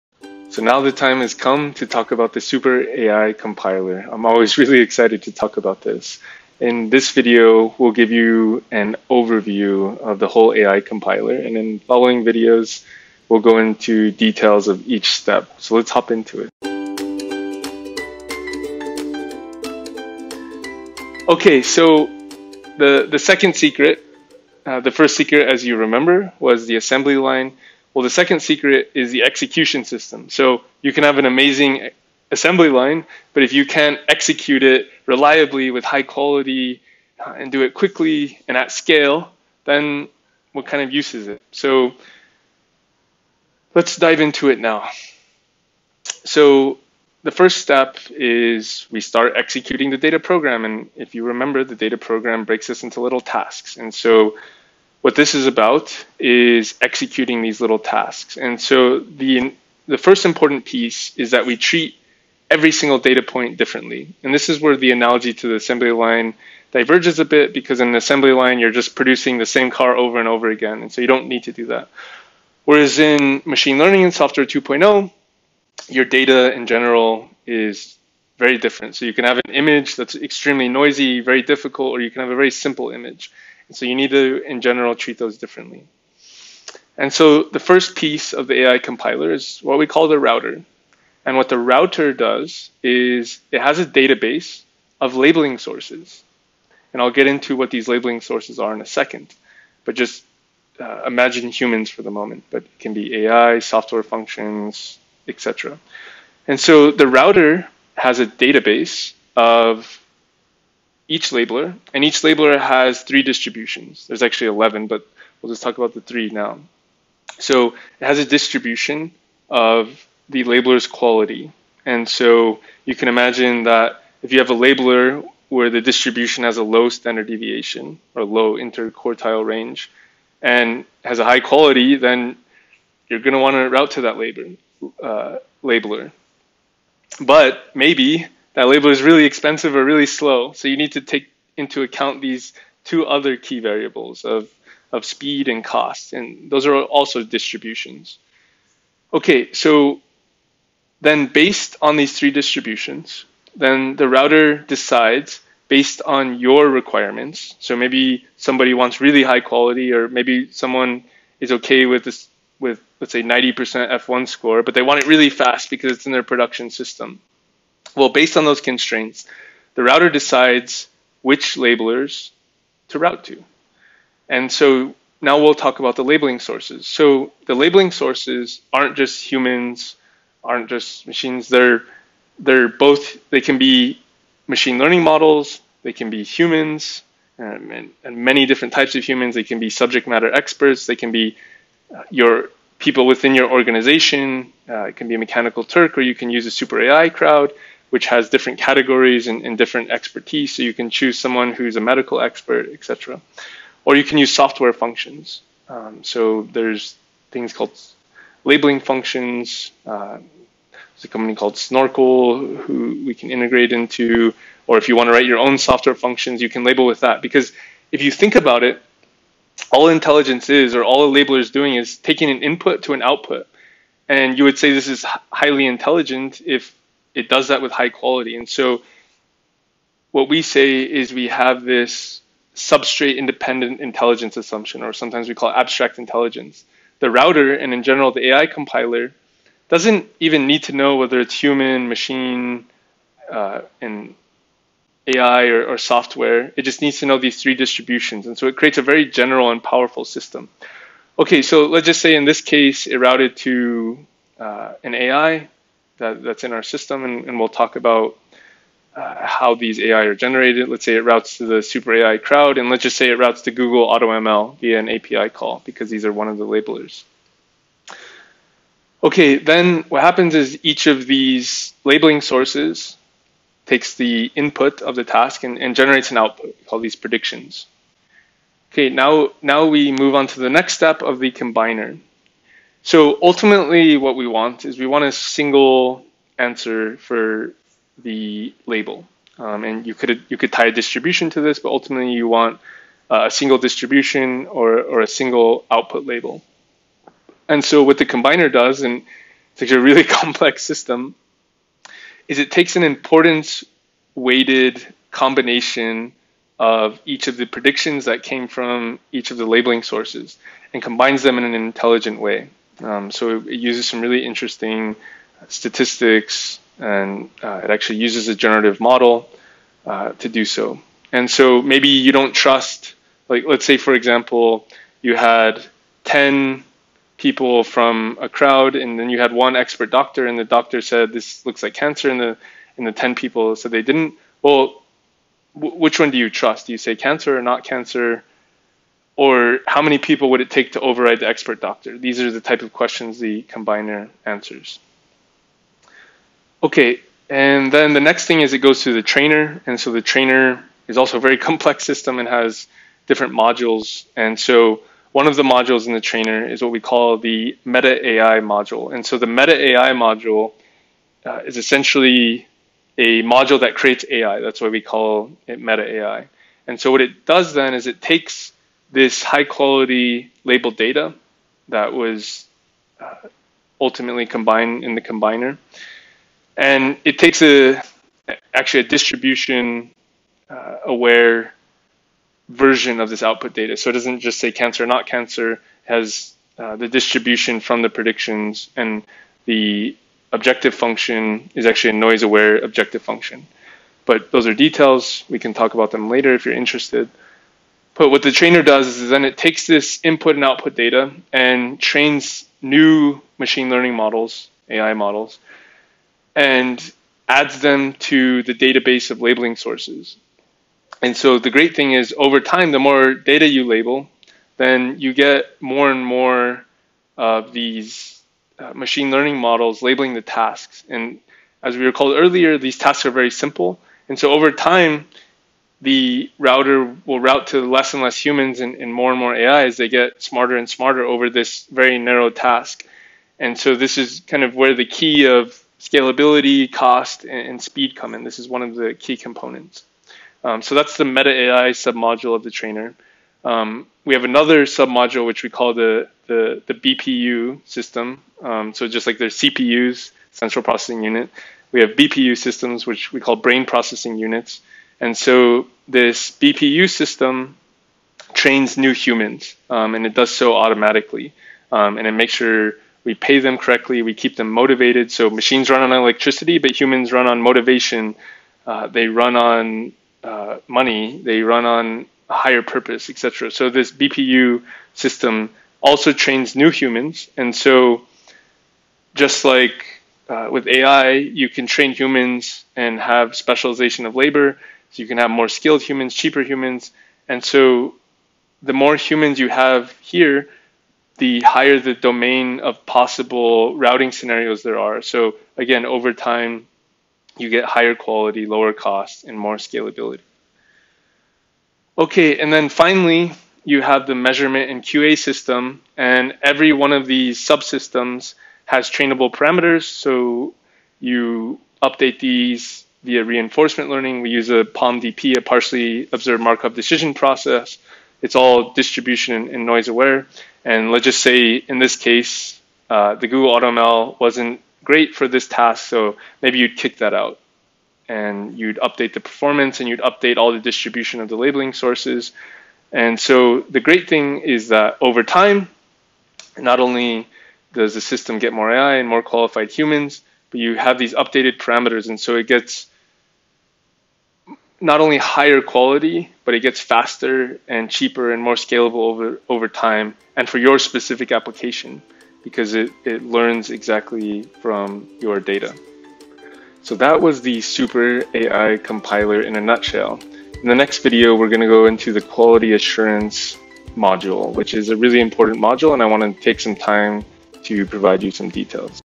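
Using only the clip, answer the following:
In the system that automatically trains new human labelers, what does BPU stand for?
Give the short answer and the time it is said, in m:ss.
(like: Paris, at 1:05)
Brain processing units, at 7:33.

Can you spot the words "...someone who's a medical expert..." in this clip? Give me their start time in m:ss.
3:21.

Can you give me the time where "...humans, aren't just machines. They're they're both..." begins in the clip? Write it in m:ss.
2:59.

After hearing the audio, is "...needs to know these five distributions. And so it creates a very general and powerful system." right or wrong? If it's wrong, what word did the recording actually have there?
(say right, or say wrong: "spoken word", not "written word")
wrong: "three", not "five".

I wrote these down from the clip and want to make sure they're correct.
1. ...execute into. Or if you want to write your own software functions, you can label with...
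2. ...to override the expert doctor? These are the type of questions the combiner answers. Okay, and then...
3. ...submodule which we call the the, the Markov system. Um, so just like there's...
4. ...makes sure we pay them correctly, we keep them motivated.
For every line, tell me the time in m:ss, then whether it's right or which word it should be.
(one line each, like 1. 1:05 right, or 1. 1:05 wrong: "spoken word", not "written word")
1. 3:33 wrong: "integrate", not "execute"
2. 5:40 right
3. 7:24 wrong: "BPU", not "Markov"
4. 7:42 right.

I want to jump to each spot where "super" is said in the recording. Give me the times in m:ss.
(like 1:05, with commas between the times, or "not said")
0:02, 3:16, 4:21, 9:17.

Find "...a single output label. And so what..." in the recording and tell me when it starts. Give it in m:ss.
4:55.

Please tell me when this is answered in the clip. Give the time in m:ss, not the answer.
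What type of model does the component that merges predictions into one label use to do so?
5:18.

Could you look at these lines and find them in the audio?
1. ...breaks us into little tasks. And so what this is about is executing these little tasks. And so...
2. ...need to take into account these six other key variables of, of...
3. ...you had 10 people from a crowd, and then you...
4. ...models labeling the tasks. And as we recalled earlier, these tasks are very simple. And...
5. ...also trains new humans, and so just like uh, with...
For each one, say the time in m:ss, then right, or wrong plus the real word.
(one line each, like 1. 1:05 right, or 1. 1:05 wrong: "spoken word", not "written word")
1. 0:52 right
2. 2:20 wrong: "two", not "six"
3. 5:25 right
4. 6:59 right
5. 7:55 right.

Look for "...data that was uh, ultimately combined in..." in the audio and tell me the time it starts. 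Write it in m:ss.
6:10.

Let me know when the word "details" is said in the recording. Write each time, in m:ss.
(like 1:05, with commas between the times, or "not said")
0:14, 6:34, 9:28.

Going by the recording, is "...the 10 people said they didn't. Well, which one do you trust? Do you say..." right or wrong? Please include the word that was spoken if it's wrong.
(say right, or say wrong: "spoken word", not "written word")
right.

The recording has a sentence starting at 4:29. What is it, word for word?
Okay, then what happens is each of these labeling sources takes the input of the task and, and generates an output.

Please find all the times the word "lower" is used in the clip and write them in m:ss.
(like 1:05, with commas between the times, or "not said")
8:18.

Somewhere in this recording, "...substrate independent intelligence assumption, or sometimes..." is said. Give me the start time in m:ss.
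3:52.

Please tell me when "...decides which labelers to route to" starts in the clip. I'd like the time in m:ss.
2:50.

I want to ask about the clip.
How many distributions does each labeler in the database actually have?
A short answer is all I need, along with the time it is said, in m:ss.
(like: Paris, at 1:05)
11, at 1:54.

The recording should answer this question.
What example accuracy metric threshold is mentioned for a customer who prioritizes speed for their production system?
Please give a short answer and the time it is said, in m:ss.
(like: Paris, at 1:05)
90% F1 score, at 2:43.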